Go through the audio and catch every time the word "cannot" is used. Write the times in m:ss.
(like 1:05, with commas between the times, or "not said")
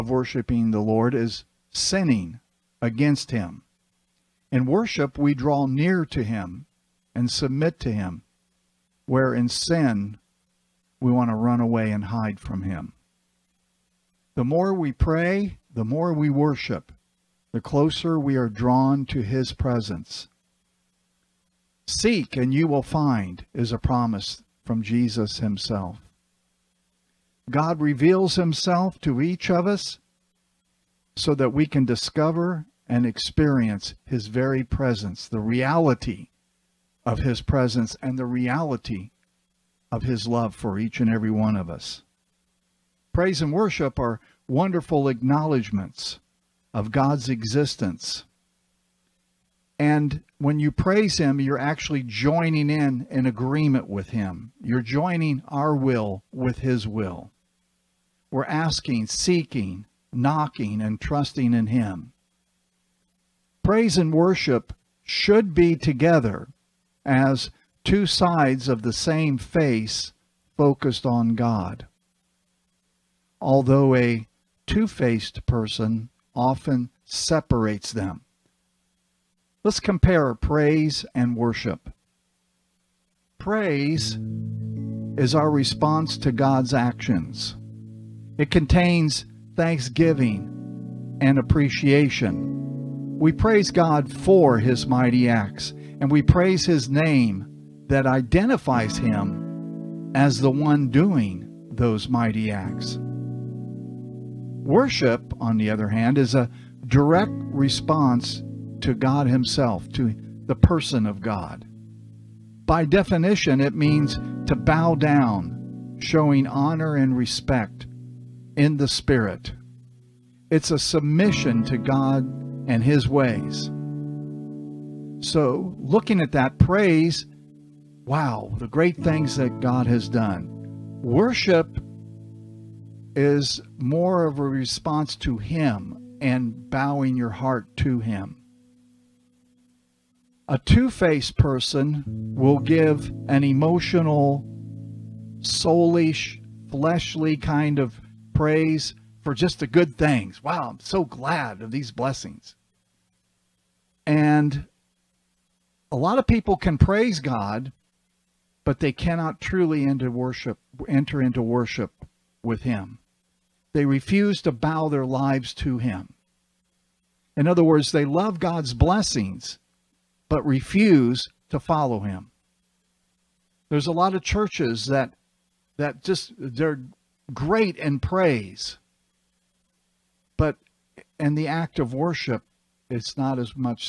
2:38.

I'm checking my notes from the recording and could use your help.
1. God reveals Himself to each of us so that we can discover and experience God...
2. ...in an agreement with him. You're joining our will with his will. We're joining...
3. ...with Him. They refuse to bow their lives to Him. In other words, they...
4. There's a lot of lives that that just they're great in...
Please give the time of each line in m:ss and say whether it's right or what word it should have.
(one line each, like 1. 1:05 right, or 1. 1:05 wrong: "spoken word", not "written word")
1. 0:27 wrong: "His", not "God"
2. 0:52 wrong: "asking", not "joining"
3. 2:42 right
4. 2:53 wrong: "churches", not "lives".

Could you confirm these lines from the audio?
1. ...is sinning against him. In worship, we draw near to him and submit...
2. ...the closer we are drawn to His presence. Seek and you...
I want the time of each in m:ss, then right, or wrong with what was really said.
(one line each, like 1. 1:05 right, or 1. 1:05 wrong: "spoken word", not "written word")
1. 0:01 right
2. 0:17 right.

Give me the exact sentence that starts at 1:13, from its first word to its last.
Although a two-faced person often separates them.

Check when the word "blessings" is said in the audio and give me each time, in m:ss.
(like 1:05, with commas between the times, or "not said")
2:31, 2:48.